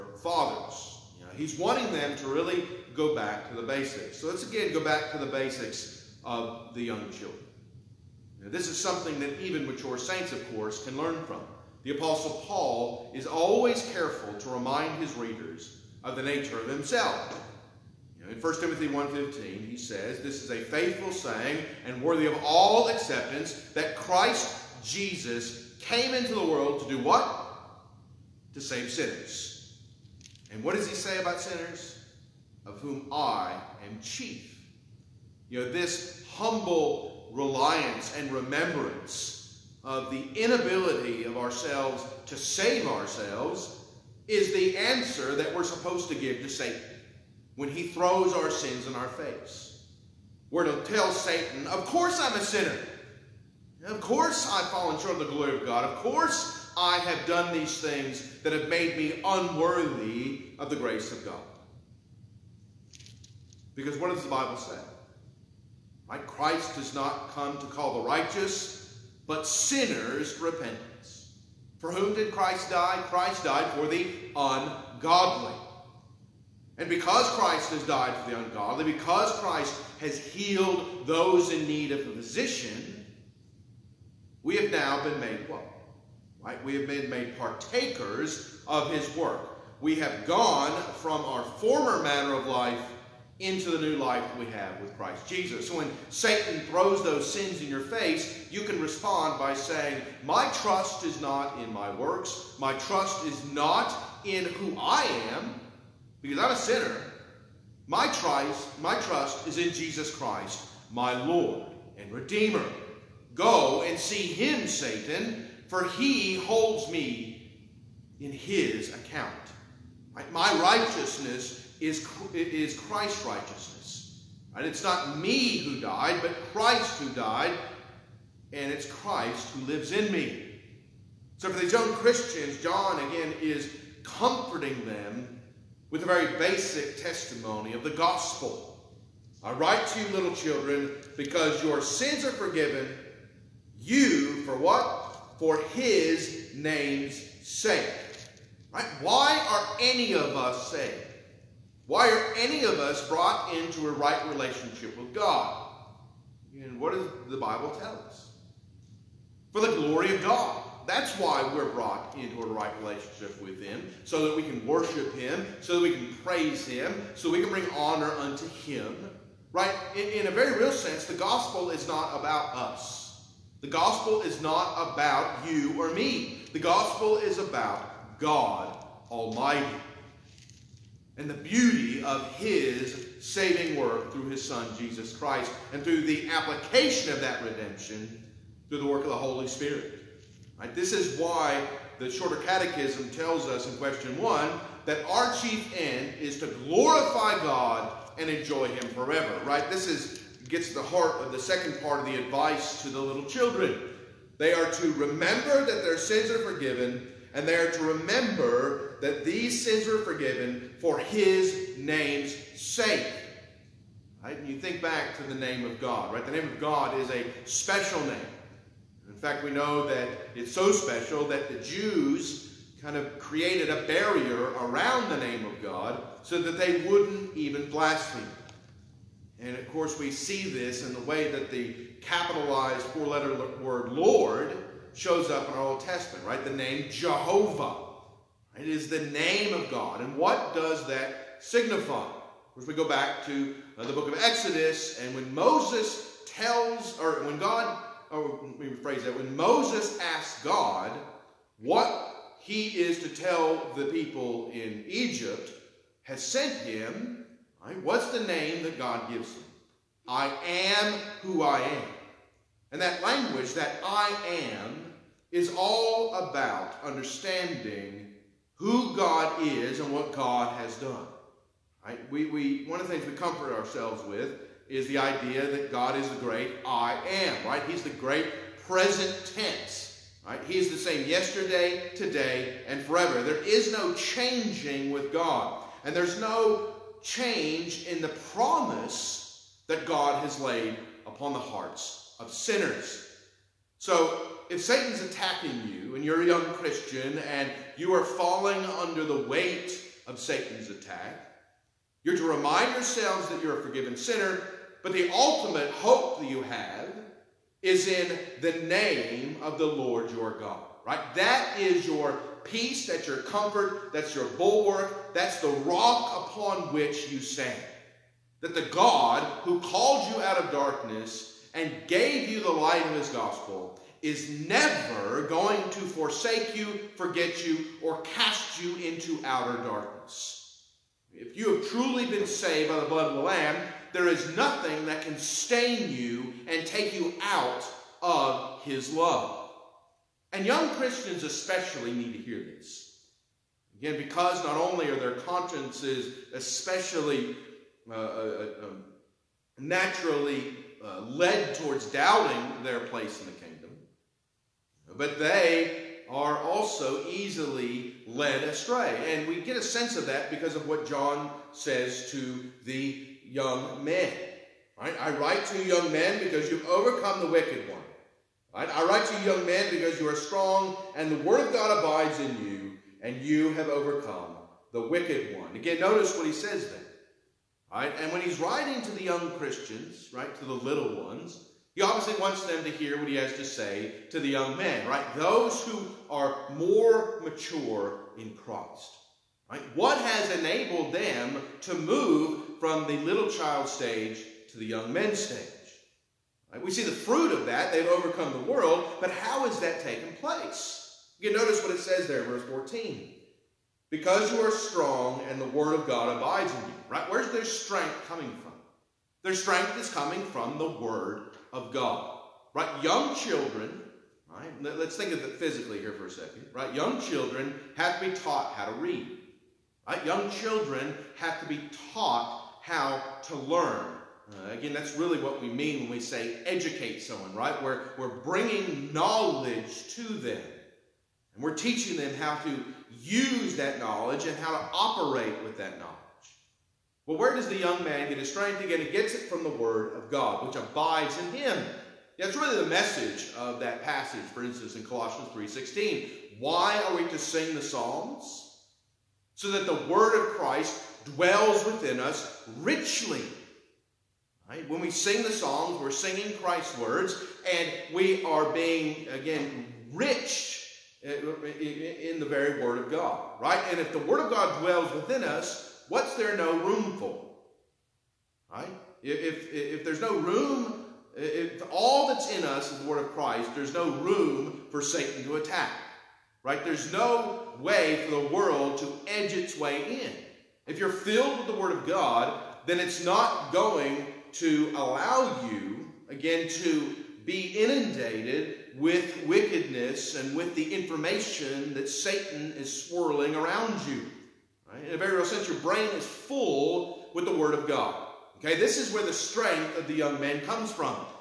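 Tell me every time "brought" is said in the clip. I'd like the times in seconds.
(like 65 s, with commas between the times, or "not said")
153 s, 161 s.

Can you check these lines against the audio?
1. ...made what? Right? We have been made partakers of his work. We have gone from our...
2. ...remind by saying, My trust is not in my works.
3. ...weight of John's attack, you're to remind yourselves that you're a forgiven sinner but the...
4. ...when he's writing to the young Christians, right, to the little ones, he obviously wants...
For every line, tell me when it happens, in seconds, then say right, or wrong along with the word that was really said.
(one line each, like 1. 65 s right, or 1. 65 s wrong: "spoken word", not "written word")
1. 85 s right
2. 98 s wrong: "respond", not "remind"
3. 299 s wrong: "Satan", not "John"
4. 378 s right.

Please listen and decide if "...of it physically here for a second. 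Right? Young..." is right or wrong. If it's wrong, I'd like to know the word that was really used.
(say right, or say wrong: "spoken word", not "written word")
right.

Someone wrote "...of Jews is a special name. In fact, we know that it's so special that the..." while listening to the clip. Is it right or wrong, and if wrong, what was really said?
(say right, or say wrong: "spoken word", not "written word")
wrong: "God", not "Jews".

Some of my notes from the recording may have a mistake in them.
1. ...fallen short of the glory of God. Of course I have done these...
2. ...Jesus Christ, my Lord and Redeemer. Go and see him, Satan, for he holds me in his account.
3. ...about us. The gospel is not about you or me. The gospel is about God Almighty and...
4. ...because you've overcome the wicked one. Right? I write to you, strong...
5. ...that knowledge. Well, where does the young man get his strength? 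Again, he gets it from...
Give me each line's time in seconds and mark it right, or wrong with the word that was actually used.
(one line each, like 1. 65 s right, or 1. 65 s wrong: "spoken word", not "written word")
1. 54 s right
2. 109 s right
3. 172 s right
4. 366 s wrong: "young", not "strong"
5. 435 s right.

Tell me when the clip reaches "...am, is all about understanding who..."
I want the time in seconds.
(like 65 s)
264 s.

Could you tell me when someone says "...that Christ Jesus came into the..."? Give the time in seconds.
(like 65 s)
23 s.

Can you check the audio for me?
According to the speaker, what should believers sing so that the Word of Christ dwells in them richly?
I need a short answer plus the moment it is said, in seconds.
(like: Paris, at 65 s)
The Psalms, at 447 s.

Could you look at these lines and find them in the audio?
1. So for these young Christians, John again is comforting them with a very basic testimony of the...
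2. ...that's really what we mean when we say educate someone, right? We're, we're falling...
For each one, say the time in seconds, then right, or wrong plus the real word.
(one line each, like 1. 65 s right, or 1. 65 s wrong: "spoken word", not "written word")
1. 131 s right
2. 424 s wrong: "bringing", not "falling".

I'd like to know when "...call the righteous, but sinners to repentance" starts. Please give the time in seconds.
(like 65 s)
67 s.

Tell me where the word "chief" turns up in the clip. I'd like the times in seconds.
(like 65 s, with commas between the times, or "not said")
34 s, 195 s.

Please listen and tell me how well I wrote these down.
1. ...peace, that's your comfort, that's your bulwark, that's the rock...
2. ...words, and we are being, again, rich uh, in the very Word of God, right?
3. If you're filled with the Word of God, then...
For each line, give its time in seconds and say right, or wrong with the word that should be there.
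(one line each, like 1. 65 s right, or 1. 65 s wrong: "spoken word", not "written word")
1. 312 s right
2. 456 s right
3. 480 s right.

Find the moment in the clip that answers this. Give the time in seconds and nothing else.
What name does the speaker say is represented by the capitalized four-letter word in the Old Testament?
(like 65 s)
236 s.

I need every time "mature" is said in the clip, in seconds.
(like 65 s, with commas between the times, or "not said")
9 s, 387 s.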